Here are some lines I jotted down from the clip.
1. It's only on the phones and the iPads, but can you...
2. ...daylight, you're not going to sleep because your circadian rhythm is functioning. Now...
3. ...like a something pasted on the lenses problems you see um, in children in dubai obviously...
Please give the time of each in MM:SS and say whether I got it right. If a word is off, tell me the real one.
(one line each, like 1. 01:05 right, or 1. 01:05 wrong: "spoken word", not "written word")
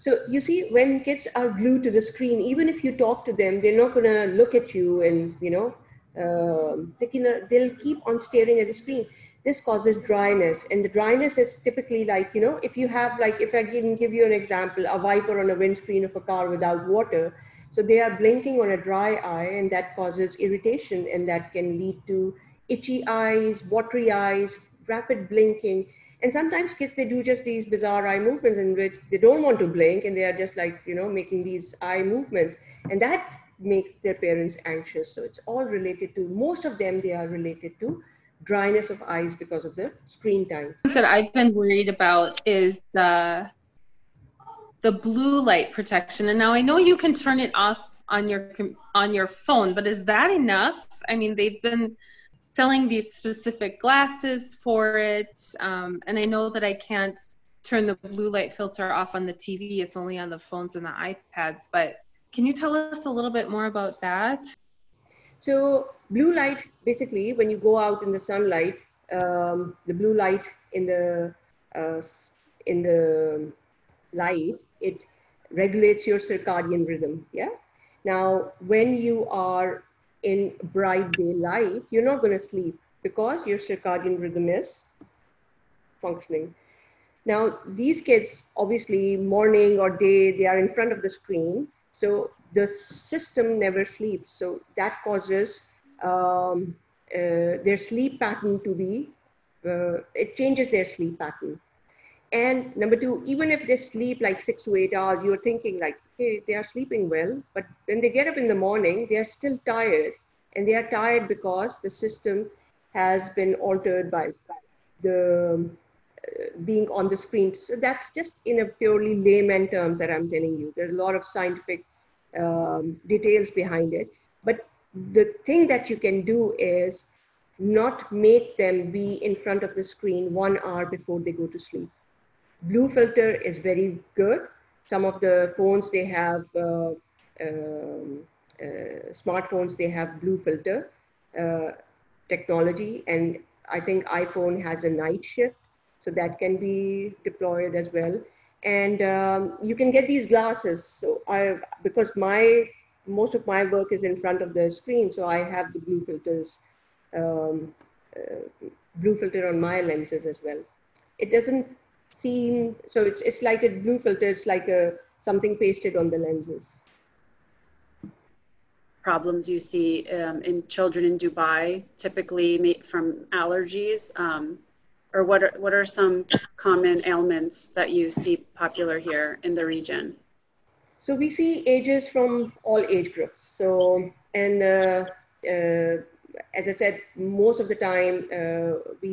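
1. 00:59 right
2. 01:21 right
3. 02:44 wrong: "typically", not "obviously".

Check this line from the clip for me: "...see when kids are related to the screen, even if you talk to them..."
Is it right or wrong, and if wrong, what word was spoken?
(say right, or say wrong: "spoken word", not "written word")
wrong: "glued", not "related".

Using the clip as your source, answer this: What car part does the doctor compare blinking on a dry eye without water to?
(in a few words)
wiper on a windscreen.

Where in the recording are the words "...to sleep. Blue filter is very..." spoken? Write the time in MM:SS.
02:11.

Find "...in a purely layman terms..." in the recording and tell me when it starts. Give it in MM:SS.
01:58.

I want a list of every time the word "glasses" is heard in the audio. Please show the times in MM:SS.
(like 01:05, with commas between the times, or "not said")
00:53, 02:30.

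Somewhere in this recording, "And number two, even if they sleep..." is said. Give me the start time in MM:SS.
01:42.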